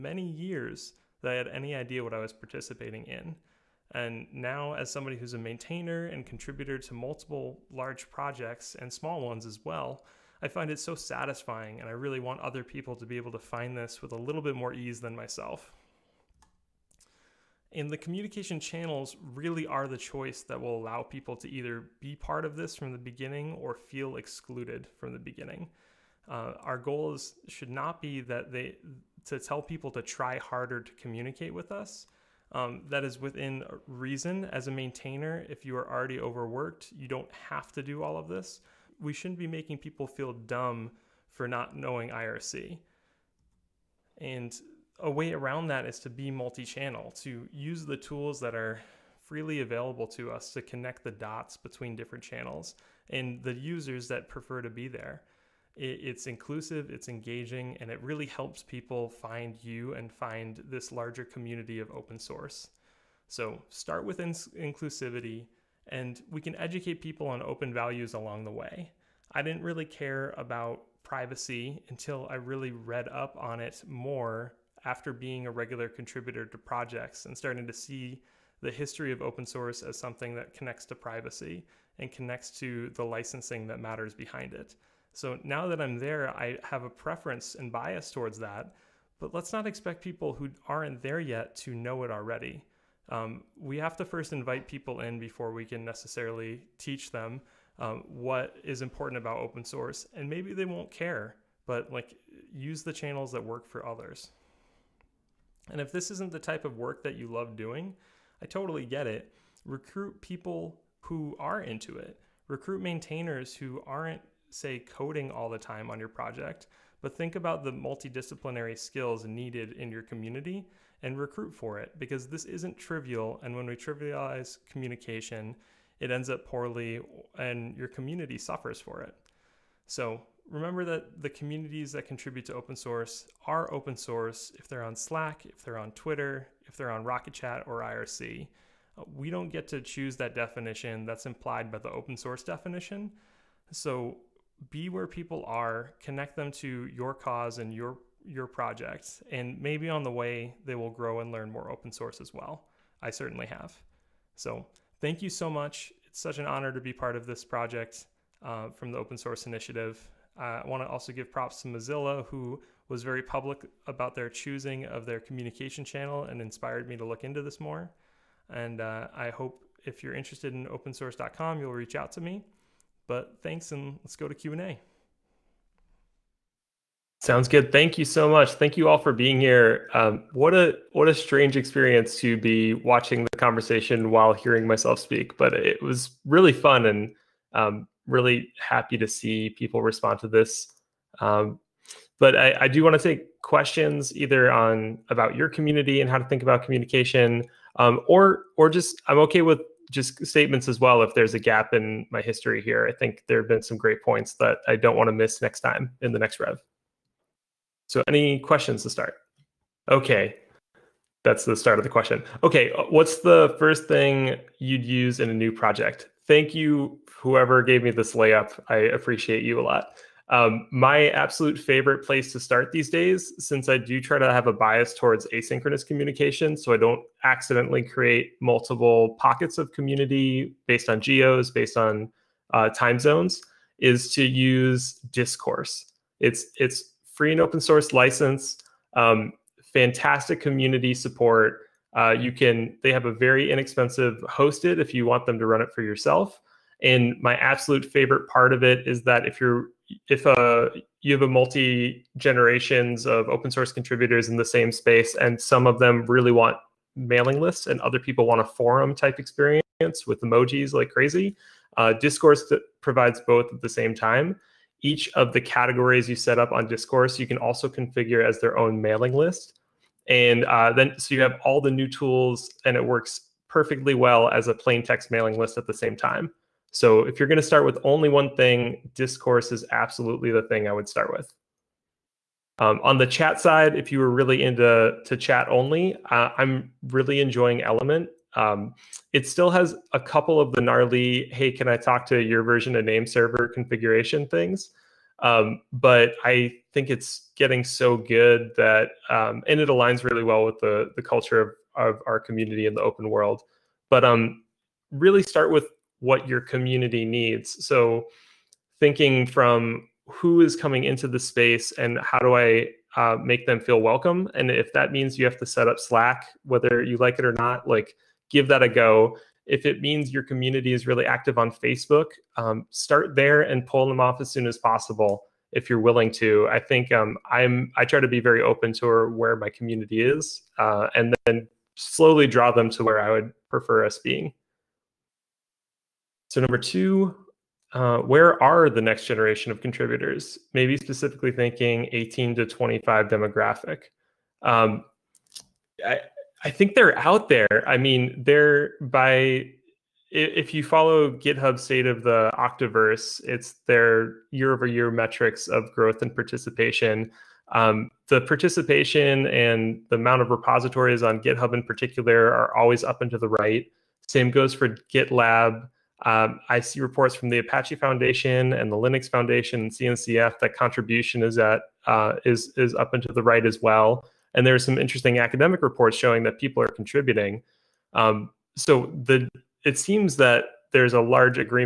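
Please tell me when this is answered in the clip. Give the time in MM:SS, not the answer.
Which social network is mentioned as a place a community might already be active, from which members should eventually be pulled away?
05:21.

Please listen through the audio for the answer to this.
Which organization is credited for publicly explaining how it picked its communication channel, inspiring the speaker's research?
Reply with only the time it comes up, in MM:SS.
02:41.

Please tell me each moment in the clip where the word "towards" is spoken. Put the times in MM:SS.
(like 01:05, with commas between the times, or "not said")
01:28, 03:44.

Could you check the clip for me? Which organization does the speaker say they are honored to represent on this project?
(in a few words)
Open Source Initiative.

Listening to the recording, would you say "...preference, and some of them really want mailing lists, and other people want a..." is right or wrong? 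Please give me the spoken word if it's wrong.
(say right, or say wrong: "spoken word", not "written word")
wrong: "space", not "preference".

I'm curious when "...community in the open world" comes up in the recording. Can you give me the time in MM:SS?
05:02.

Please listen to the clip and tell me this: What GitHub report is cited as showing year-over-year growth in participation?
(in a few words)
State of the Octoverse.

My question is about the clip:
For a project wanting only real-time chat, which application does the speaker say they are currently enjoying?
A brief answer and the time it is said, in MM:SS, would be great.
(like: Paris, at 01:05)
Element, at 04:47.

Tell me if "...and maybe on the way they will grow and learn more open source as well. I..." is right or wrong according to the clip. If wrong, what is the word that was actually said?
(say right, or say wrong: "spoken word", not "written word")
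right.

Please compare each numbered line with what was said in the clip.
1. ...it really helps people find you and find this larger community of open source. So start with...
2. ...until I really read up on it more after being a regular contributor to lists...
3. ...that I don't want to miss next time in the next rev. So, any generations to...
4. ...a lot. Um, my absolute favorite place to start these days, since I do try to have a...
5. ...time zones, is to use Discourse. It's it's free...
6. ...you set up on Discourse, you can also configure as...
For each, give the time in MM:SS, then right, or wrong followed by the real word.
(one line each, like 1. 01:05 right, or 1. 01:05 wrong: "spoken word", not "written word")
1. 00:57 right
2. 01:11 wrong: "projects", not "lists"
3. 03:24 wrong: "questions", not "generations"
4. 03:39 right
5. 03:52 right
6. 04:26 right.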